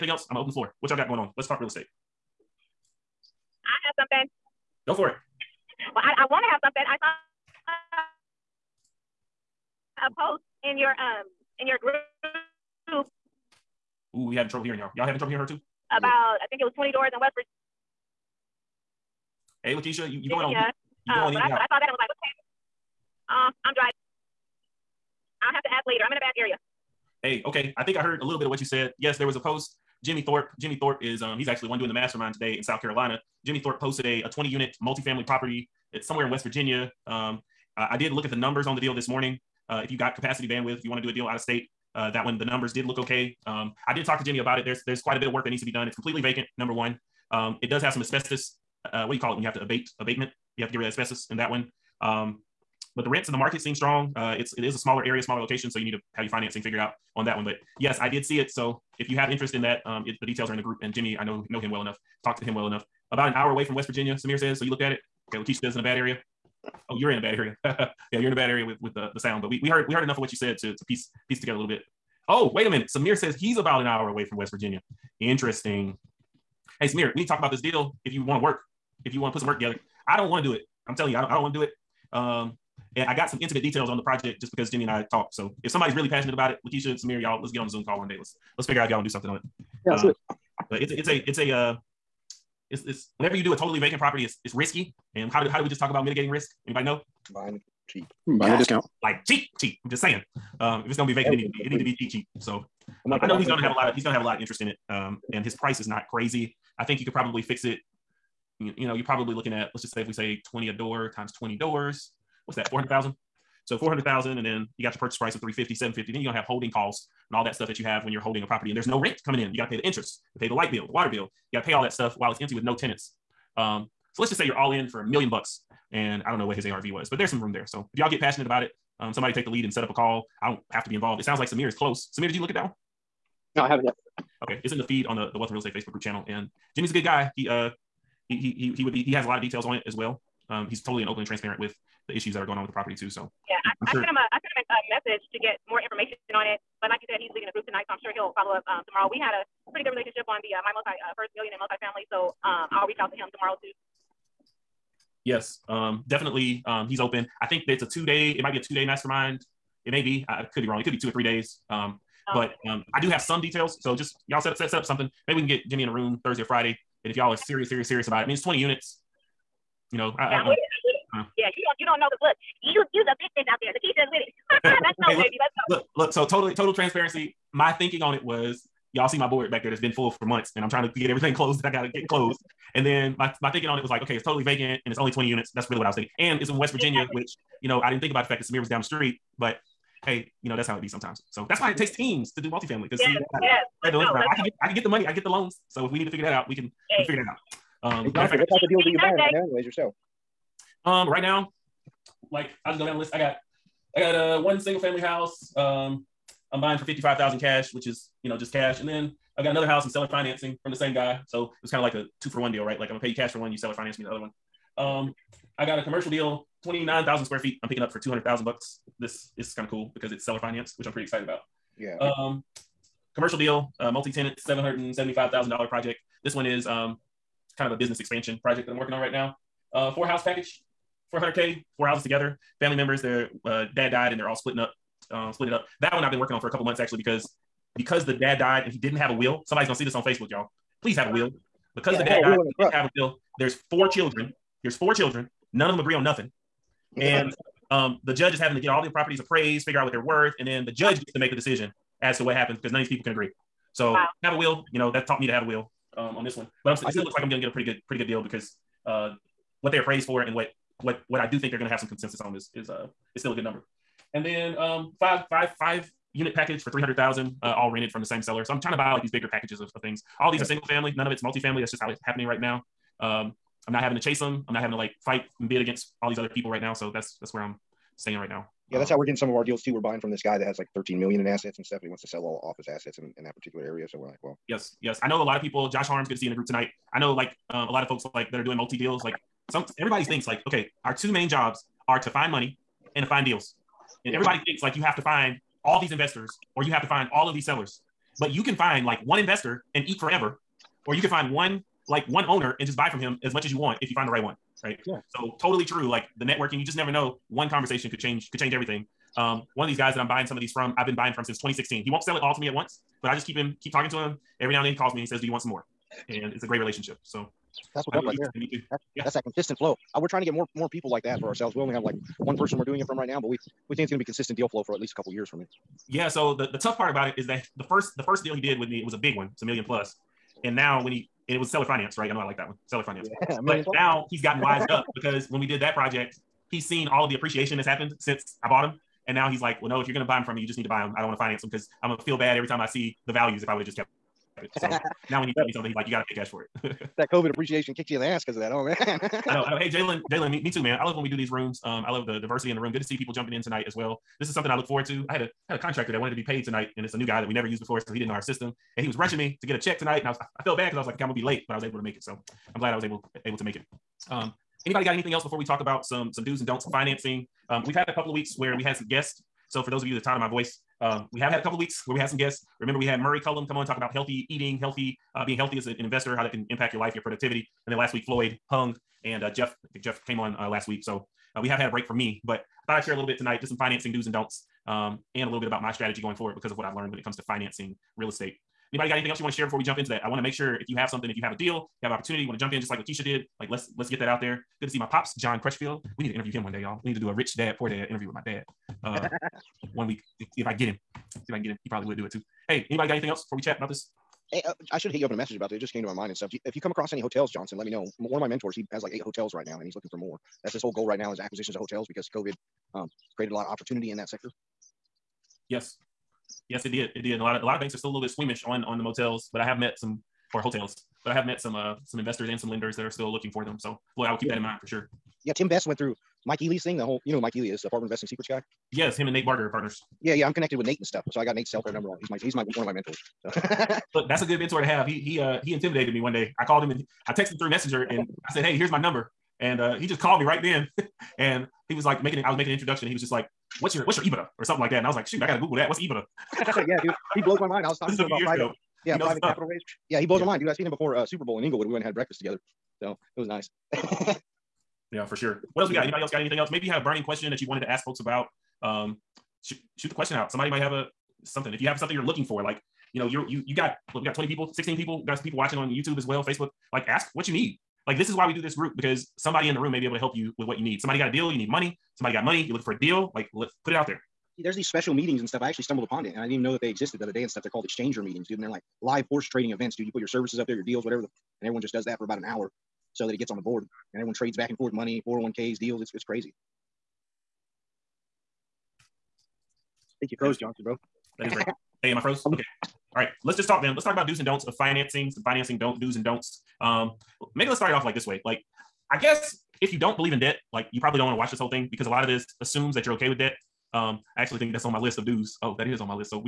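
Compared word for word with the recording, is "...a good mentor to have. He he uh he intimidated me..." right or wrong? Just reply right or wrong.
right.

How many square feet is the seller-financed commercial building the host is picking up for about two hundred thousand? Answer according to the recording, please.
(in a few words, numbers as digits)
29,000.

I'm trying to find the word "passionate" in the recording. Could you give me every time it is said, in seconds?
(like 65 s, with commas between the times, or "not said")
86 s, 128 s.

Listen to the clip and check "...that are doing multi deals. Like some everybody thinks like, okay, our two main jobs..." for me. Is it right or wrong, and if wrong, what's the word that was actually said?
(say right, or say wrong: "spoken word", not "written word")
right.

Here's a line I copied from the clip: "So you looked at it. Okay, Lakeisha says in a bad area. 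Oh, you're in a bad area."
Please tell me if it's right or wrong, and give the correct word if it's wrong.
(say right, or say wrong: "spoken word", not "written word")
right.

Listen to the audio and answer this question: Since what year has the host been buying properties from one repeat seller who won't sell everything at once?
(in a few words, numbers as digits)
2016.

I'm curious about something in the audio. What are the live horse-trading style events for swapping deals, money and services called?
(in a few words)
Exchanger meetings.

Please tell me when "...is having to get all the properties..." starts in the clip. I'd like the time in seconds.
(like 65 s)
248 s.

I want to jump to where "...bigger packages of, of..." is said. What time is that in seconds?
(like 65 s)
269 s.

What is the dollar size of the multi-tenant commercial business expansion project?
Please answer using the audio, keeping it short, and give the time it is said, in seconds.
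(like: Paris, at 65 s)
$775,000, at 224 s.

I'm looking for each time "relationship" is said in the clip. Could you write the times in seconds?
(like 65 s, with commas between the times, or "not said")
149 s, 316 s.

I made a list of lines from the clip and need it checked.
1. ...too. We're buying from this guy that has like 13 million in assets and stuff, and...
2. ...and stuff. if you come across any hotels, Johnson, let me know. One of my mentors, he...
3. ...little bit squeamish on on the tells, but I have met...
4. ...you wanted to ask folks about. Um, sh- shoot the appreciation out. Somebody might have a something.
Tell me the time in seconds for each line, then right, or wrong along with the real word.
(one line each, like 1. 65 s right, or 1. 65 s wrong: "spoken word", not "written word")
1. 279 s right
2. 406 s right
3. 417 s wrong: "motels", not "tells"
4. 457 s wrong: "question", not "appreciation".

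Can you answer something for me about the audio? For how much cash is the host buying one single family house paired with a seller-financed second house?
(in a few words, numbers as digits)
$55,000.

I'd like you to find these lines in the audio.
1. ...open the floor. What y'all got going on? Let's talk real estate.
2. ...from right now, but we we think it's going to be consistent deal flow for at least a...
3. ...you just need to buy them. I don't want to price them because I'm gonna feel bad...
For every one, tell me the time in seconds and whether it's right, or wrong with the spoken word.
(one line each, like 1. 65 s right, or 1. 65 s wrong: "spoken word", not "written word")
1. 0 s right
2. 322 s right
3. 340 s wrong: "finance", not "price".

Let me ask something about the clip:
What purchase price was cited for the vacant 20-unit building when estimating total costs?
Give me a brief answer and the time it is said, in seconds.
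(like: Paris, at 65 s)
350, at 115 s.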